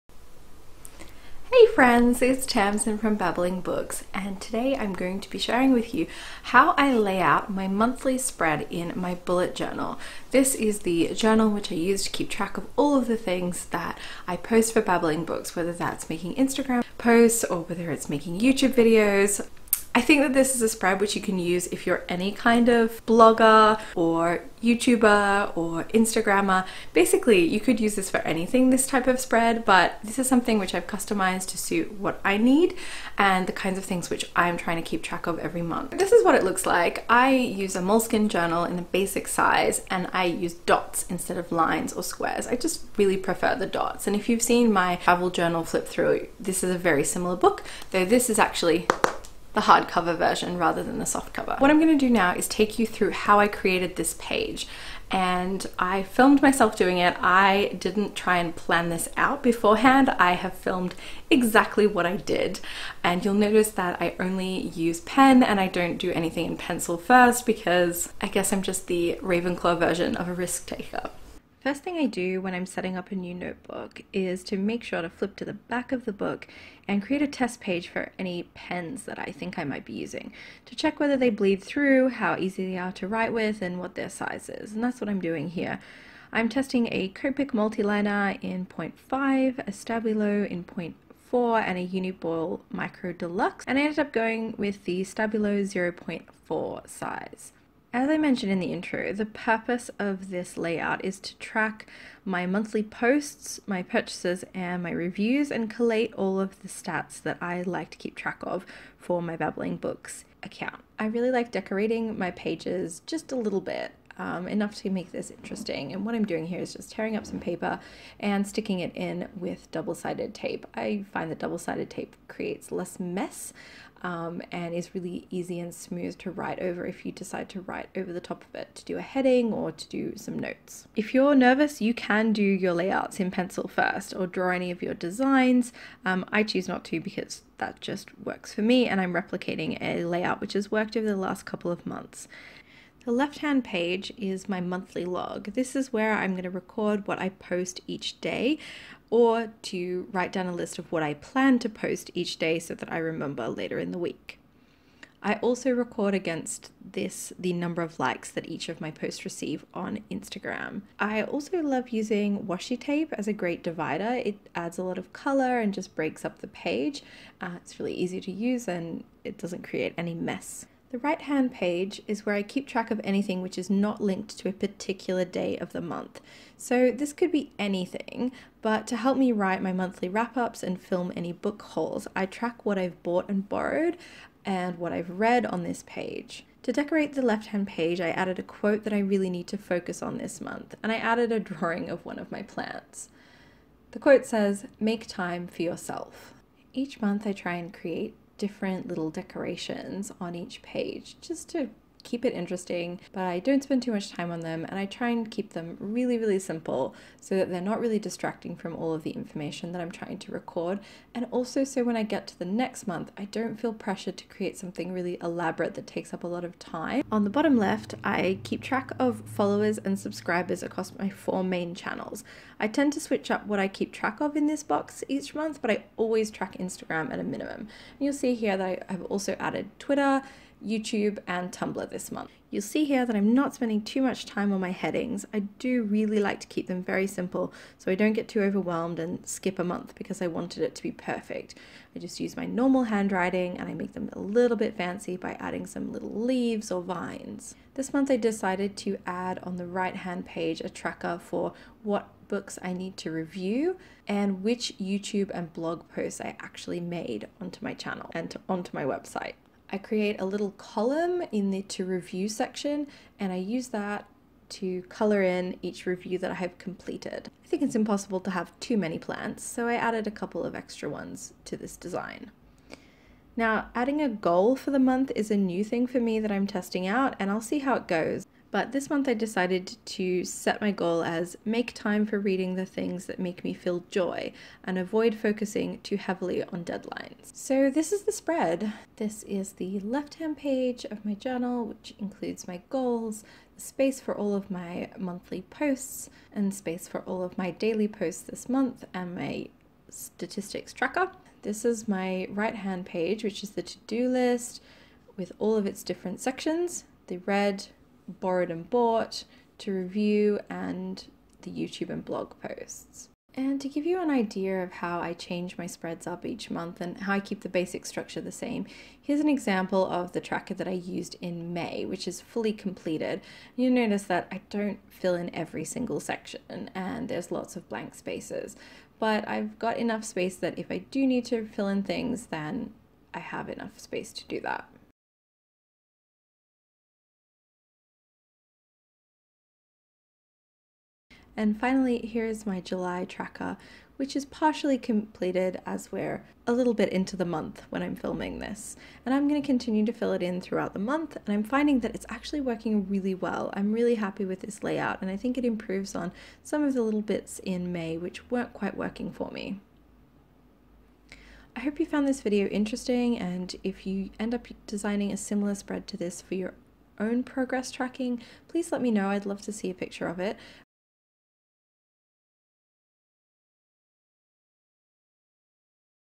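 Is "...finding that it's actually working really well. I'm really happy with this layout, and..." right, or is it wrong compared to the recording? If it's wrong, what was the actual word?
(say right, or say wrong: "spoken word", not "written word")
right.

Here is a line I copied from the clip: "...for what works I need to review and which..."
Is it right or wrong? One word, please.
wrong.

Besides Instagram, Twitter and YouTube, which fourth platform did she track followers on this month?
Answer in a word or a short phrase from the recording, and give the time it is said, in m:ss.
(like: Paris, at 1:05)
Tumblr, at 3:51.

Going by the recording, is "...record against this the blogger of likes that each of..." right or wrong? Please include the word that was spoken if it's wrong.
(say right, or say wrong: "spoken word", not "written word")
wrong: "number", not "blogger".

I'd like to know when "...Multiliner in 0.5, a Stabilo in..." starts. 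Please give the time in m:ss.
1:27.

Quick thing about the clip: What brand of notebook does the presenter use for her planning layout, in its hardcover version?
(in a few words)
Moleskine.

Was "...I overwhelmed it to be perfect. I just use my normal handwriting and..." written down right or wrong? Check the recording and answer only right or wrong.
wrong.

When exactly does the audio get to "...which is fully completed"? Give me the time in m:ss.
5:21.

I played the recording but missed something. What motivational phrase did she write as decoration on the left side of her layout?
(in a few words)
Make time for yourself.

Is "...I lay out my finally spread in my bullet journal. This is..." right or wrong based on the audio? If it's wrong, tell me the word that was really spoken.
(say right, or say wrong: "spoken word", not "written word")
wrong: "monthly", not "finally".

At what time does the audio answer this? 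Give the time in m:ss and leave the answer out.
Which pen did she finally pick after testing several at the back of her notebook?
1:35.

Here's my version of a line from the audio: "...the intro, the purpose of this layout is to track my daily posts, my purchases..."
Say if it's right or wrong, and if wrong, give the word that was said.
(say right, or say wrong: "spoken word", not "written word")
wrong: "monthly", not "daily".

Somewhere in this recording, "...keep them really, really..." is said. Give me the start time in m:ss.
3:25.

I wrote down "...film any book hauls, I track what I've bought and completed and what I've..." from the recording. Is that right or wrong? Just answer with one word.
wrong.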